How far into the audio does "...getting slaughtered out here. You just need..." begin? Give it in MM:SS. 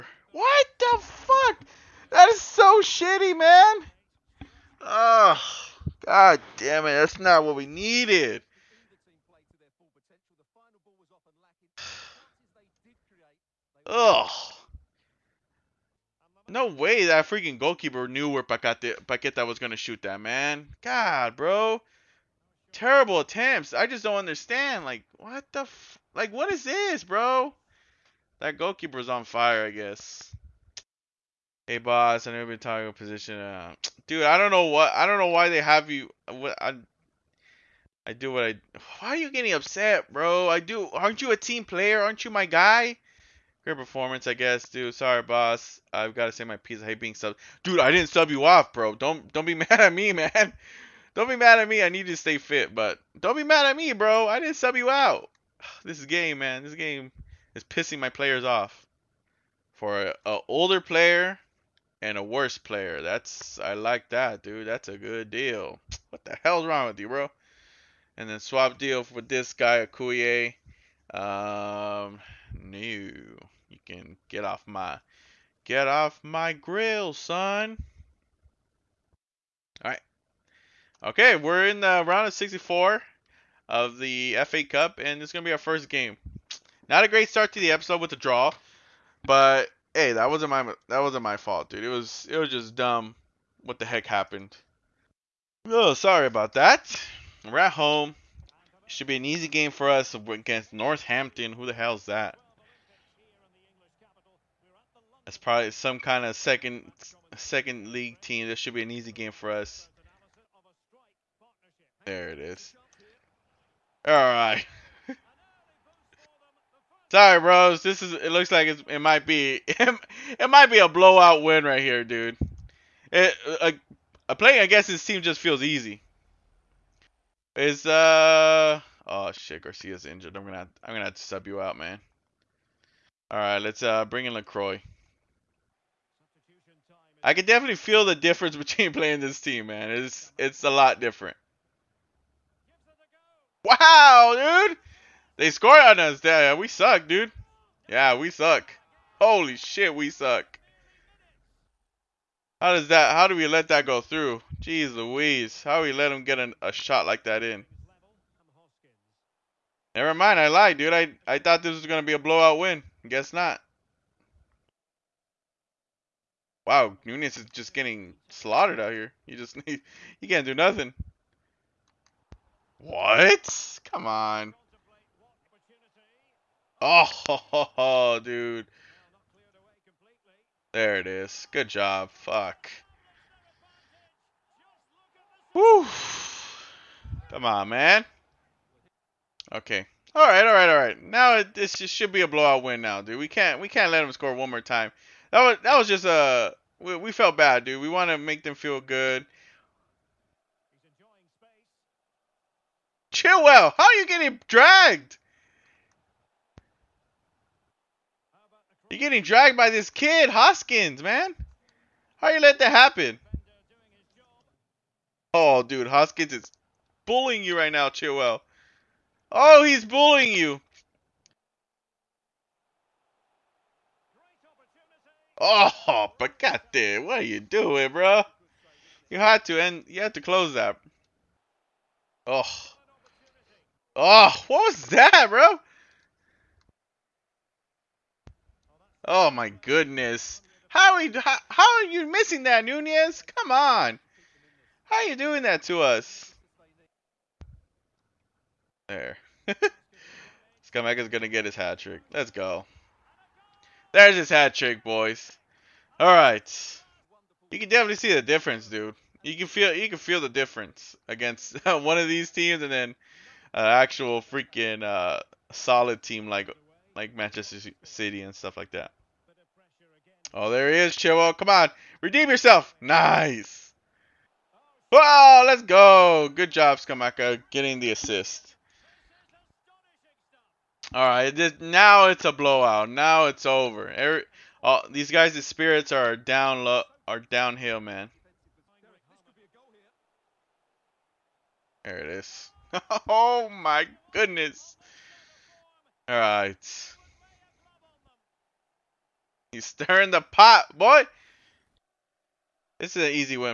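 02:47.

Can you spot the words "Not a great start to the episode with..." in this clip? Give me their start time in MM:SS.
01:26.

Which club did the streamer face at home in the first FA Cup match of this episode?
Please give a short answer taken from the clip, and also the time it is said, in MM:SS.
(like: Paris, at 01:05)
Northampton, at 01:40.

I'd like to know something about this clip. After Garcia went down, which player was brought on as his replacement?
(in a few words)
Lacroix.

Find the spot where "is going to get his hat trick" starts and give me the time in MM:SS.
04:09.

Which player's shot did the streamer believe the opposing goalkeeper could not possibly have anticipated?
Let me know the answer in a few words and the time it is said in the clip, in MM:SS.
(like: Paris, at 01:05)
Paqueta, at 00:18.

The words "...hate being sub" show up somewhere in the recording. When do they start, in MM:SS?
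00:46.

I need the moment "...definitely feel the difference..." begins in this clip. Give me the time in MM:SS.
02:17.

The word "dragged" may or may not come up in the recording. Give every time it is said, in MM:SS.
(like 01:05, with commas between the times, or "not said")
03:24, 03:29.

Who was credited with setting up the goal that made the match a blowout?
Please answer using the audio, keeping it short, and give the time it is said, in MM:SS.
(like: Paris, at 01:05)
Scamacca, at 04:36.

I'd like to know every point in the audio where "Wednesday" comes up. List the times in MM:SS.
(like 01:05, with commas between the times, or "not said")
not said.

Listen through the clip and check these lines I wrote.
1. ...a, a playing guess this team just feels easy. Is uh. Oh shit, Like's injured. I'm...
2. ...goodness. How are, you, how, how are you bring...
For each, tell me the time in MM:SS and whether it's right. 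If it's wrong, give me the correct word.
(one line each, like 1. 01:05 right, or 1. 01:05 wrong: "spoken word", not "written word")
1. 02:03 wrong: "Garcia", not "Like"
2. 03:59 wrong: "missing", not "bring".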